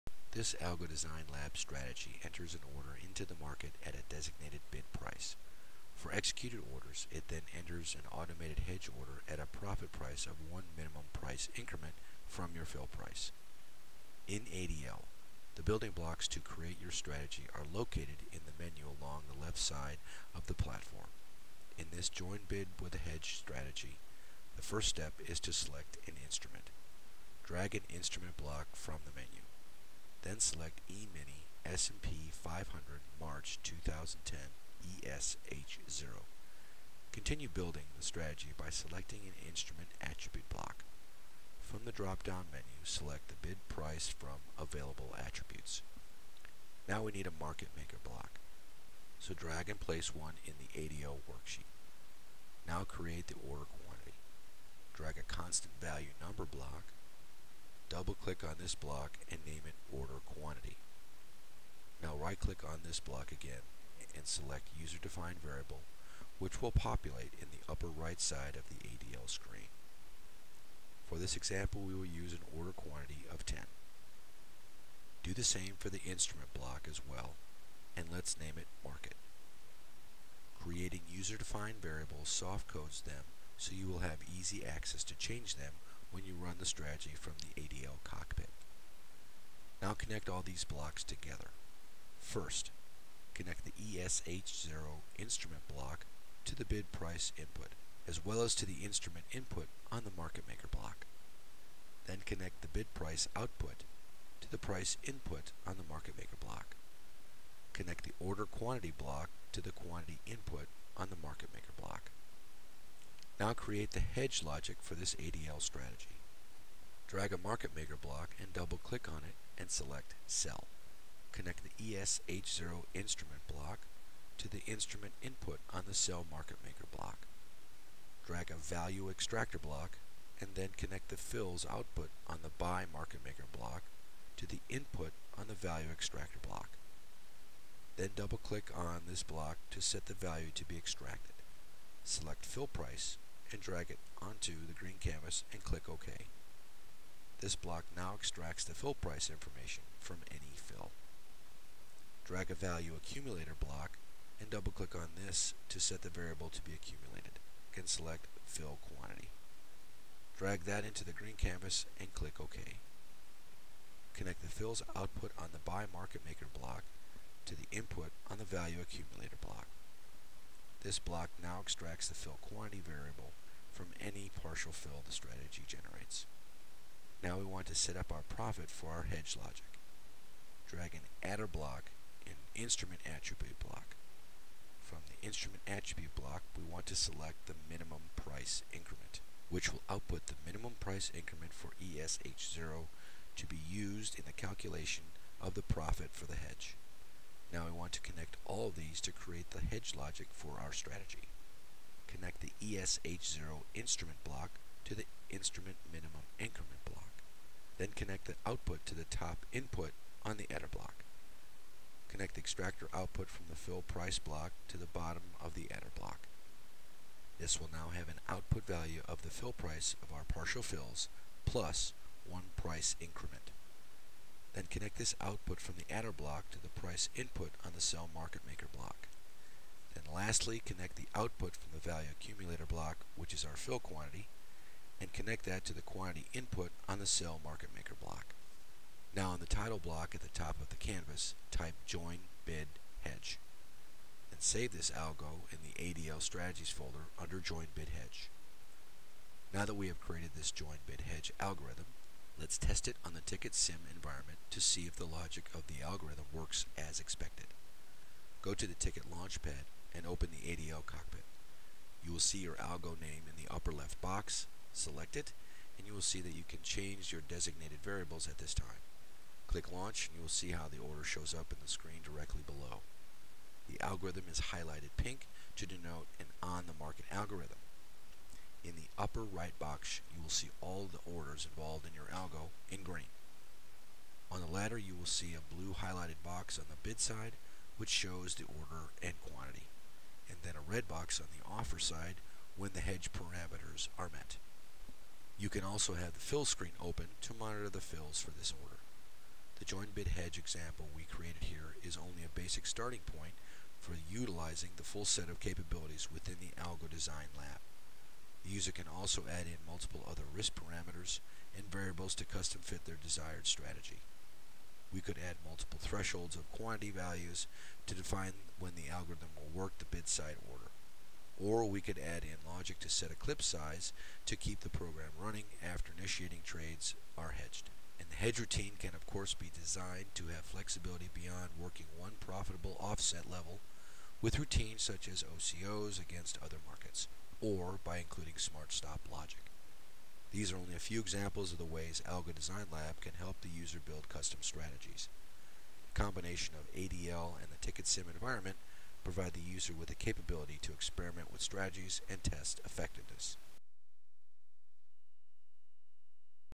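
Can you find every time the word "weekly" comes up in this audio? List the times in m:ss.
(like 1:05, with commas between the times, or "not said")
not said.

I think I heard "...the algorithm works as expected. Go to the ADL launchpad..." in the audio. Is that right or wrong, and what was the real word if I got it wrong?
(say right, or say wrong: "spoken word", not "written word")
wrong: "TickIt", not "ADL".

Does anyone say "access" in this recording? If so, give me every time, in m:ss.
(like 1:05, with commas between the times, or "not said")
1:24.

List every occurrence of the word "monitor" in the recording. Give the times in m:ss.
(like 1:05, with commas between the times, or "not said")
4:57.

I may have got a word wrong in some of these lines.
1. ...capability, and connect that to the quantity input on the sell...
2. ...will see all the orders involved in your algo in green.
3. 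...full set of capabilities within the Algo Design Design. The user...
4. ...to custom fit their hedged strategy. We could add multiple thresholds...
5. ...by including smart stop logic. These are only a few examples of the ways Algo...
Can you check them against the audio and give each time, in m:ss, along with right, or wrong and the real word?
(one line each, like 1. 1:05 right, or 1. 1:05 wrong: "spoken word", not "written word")
1. 3:53 wrong: "quantity", not "capability"
2. 4:40 right
3. 5:04 wrong: "Lab", not "Design"
4. 5:12 wrong: "desired", not "hedged"
5. 5:37 right.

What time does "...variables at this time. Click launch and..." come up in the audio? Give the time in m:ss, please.
4:27.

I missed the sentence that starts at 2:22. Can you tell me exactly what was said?
Select fill price and drag it onto the green canvas and click OK.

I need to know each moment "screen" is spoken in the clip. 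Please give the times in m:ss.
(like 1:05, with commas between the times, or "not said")
1:09, 4:31, 4:56.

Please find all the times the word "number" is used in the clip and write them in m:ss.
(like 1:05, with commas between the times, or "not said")
0:56.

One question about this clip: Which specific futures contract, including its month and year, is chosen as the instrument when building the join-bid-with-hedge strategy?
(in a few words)
E-mini S&P 500 March 2010.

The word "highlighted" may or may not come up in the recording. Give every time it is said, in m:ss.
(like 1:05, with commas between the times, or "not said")
4:34, 4:45.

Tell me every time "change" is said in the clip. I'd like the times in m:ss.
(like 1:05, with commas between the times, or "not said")
1:25, 4:26.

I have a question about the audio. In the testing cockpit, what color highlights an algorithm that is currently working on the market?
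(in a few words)
pink.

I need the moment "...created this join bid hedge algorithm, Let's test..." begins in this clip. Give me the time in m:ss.
4:09.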